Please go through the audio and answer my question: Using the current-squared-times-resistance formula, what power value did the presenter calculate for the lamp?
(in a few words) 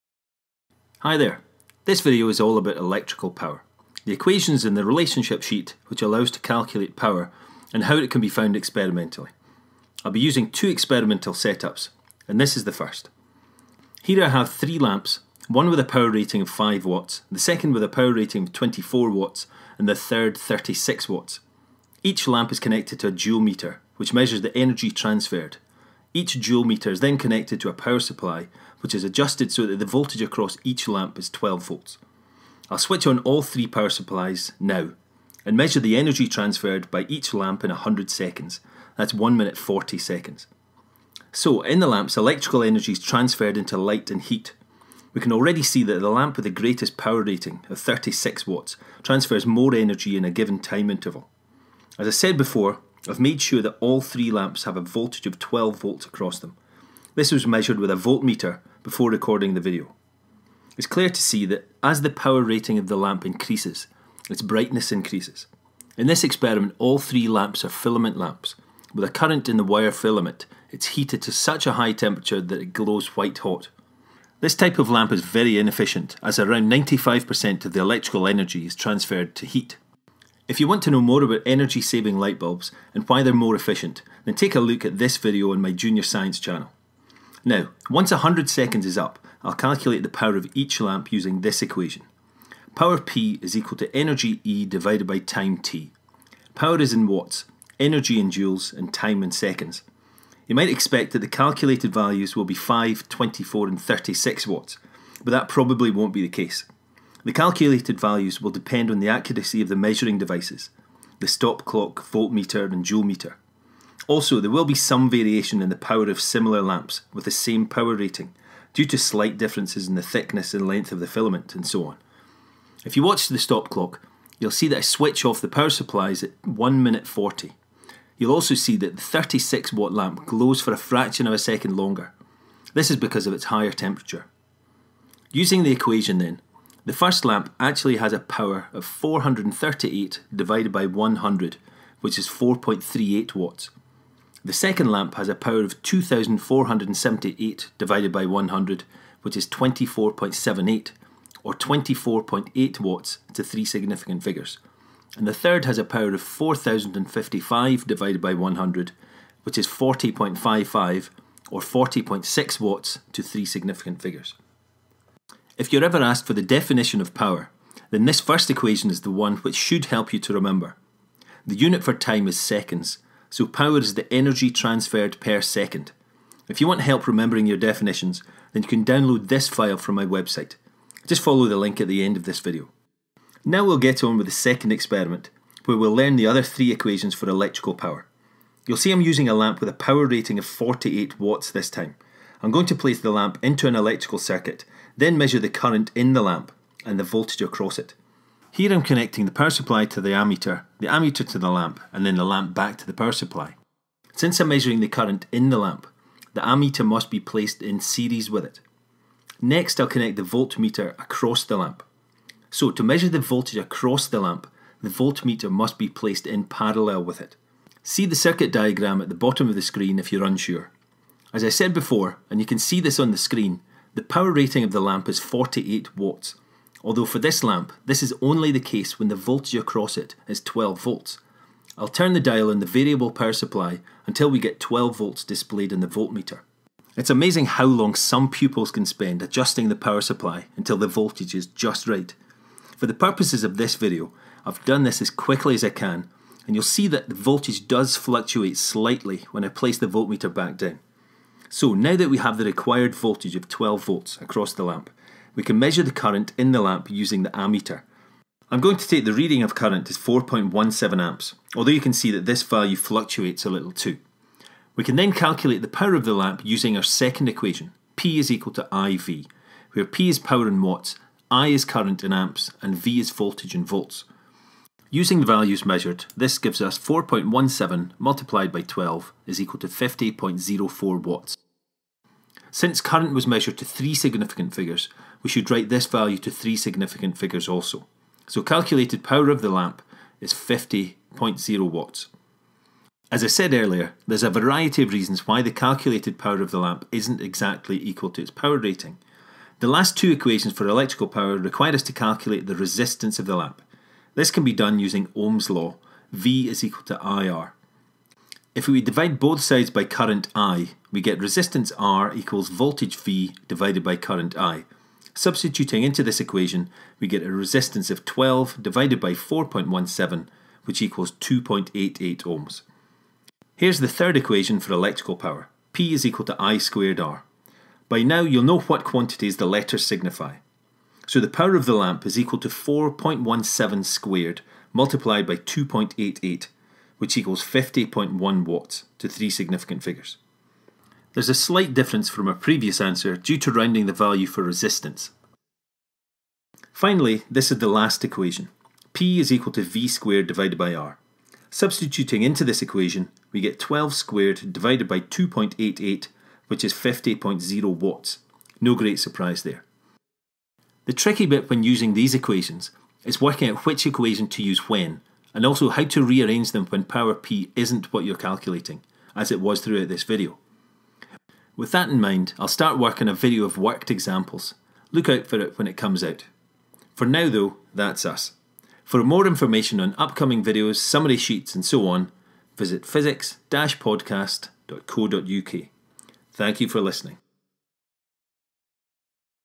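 50.1 watts.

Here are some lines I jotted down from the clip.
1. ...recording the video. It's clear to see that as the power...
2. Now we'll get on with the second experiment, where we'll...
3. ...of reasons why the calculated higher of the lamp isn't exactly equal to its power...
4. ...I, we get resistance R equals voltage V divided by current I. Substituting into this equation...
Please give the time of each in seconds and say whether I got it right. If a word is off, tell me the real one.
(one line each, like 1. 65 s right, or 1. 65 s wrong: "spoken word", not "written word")
1. 59 s right
2. 183 s right
3. 294 s wrong: "power", not "higher"
4. 310 s right.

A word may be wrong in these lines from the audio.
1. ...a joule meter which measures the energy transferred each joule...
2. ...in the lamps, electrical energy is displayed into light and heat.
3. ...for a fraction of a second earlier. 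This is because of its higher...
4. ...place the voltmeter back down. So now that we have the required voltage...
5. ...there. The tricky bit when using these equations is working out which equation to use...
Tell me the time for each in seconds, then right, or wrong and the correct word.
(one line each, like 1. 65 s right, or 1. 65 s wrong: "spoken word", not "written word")
1. 23 s right
2. 41 s wrong: "transferred", not "displayed"
3. 130 s wrong: "longer", not "earlier"
4. 249 s right
5. 359 s right.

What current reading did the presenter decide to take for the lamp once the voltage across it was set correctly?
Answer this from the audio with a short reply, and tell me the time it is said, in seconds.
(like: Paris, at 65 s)
4.17 amps, at 259 s.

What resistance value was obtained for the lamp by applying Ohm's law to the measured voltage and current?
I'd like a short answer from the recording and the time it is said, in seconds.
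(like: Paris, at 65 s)
2.88 ohms, at 321 s.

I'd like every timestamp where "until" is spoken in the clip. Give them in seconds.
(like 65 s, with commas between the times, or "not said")
234 s, 240 s.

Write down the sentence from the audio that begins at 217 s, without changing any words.
See the circuit diagram at the bottom of the screen if you're unsure.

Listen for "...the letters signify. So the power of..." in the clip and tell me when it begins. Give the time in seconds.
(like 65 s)
329 s.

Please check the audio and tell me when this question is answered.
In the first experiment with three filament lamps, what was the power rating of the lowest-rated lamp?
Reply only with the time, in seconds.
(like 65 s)
16 s.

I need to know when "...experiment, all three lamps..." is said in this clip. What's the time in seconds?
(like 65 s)
66 s.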